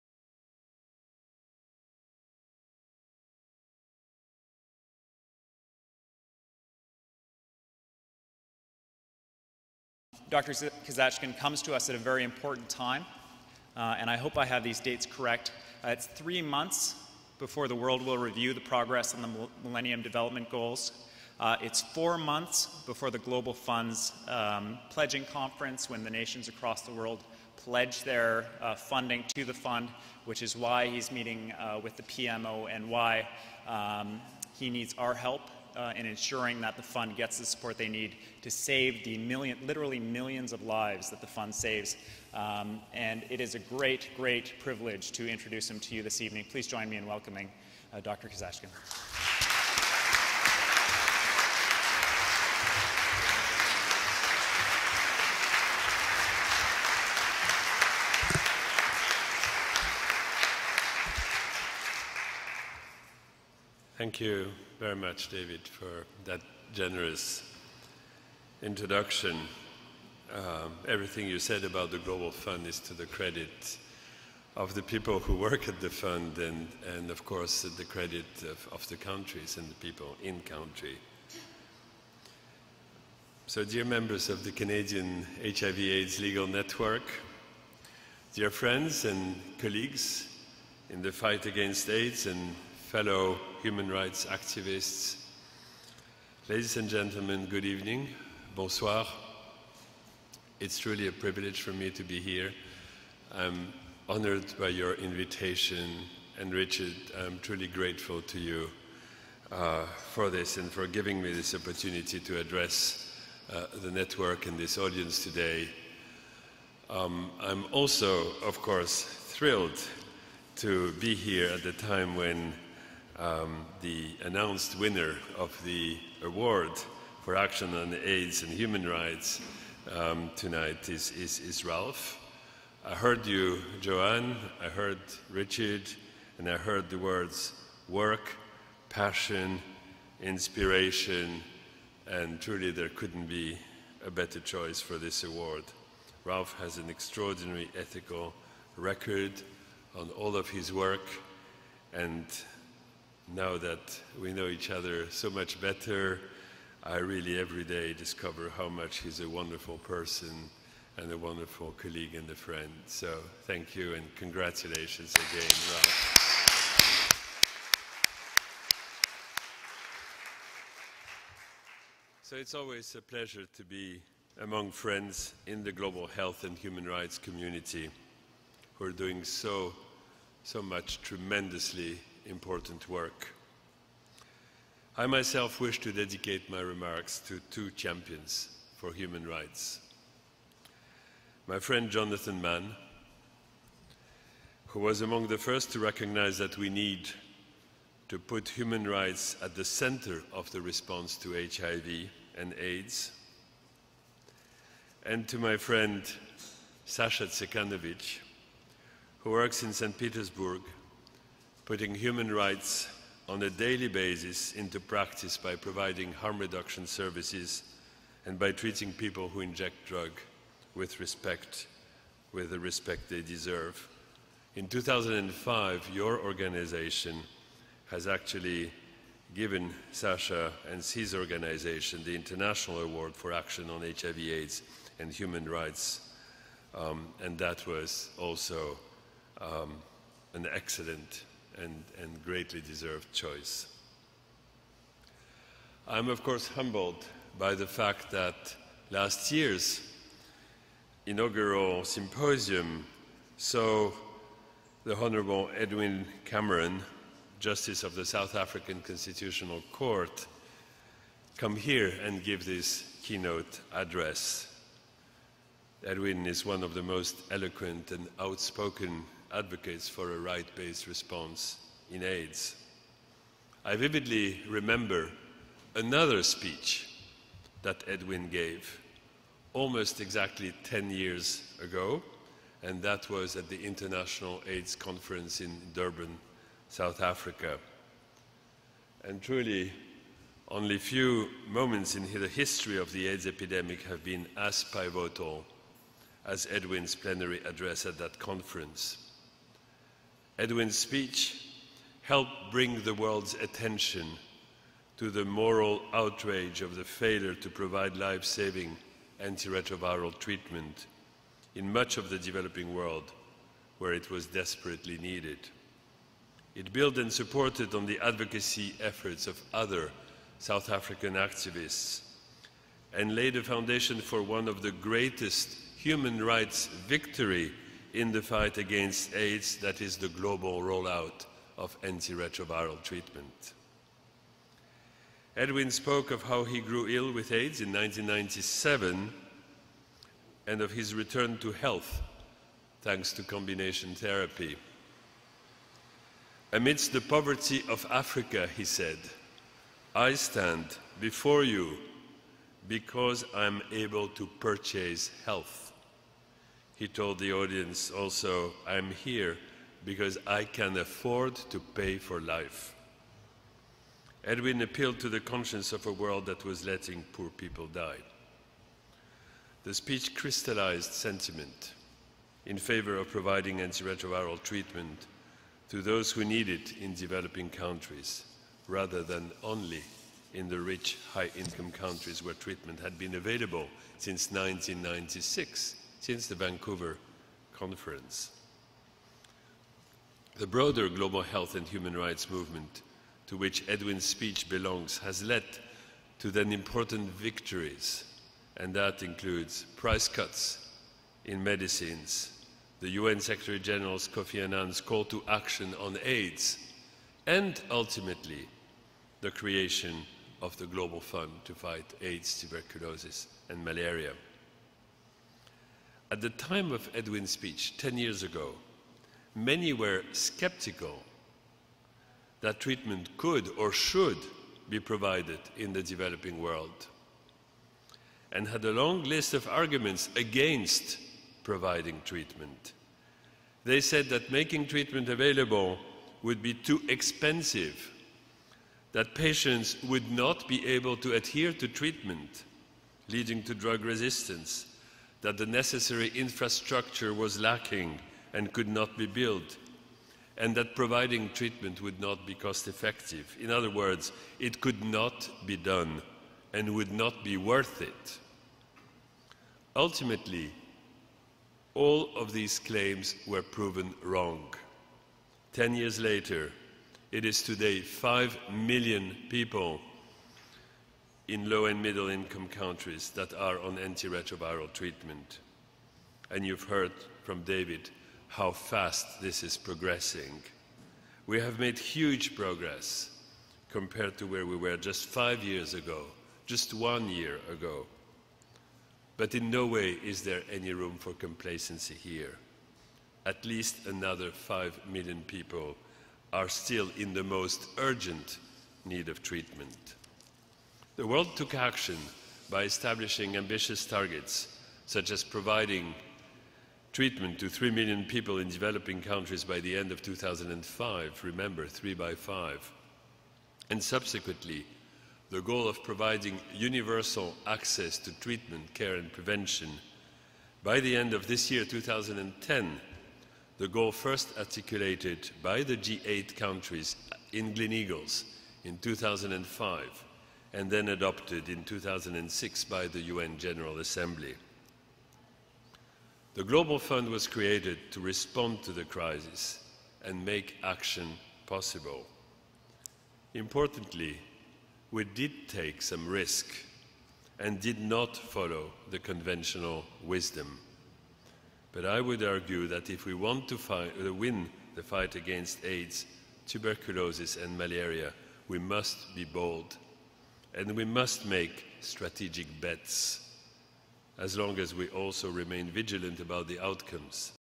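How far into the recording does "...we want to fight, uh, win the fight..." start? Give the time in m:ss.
9:13.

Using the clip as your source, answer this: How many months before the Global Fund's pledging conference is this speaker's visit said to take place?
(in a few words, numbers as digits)
4.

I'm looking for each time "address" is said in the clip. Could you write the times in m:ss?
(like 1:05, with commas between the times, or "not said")
1:52, 4:23, 4:57.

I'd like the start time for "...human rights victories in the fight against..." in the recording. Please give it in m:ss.
5:25.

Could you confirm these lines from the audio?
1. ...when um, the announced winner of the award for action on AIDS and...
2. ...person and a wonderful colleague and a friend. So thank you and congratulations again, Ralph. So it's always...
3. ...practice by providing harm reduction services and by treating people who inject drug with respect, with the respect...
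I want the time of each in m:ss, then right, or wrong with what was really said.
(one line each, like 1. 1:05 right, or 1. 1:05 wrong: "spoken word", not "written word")
1. 2:02 right
2. 2:39 right
3. 3:34 right.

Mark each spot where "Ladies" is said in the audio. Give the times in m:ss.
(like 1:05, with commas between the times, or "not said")
1:36.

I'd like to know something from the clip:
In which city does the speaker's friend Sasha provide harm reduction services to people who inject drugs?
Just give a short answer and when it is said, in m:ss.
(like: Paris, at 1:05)
St. Petersburg, at 3:29.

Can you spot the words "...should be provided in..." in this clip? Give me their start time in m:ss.
7:03.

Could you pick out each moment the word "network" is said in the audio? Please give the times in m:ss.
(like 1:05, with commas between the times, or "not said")
1:26, 1:53.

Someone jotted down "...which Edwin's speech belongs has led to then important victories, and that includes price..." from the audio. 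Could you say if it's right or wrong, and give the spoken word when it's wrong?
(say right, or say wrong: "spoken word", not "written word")
right.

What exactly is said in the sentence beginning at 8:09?
But in no way is there any room for complacency here.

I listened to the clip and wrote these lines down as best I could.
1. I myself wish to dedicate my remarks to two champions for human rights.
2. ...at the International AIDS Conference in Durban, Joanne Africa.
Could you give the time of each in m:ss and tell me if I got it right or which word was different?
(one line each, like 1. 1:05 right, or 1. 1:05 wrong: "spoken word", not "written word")
1. 3:04 right
2. 4:43 wrong: "South", not "Joanne".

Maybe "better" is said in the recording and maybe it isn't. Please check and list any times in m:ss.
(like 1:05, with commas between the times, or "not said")
2:24, 2:35.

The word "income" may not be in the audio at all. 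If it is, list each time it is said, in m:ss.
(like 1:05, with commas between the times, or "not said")
6:21, 7:52.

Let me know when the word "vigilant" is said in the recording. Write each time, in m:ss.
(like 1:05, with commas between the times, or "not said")
9:25.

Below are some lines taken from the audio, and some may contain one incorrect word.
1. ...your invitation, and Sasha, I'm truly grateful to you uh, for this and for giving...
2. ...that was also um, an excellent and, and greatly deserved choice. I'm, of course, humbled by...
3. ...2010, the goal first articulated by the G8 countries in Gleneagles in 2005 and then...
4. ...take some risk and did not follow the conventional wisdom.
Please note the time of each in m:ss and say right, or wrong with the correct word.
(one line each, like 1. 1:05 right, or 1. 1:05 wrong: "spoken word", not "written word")
1. 1:44 wrong: "Richard", not "Sasha"
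2. 3:57 right
3. 8:41 right
4. 9:05 right.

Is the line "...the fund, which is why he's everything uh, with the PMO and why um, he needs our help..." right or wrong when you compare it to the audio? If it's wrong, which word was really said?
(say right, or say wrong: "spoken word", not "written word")
wrong: "meeting", not "everything".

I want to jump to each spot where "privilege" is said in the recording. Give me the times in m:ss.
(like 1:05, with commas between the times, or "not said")
0:44, 1:41.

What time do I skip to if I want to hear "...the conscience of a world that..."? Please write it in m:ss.
6:05.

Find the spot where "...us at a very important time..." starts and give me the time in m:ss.
0:11.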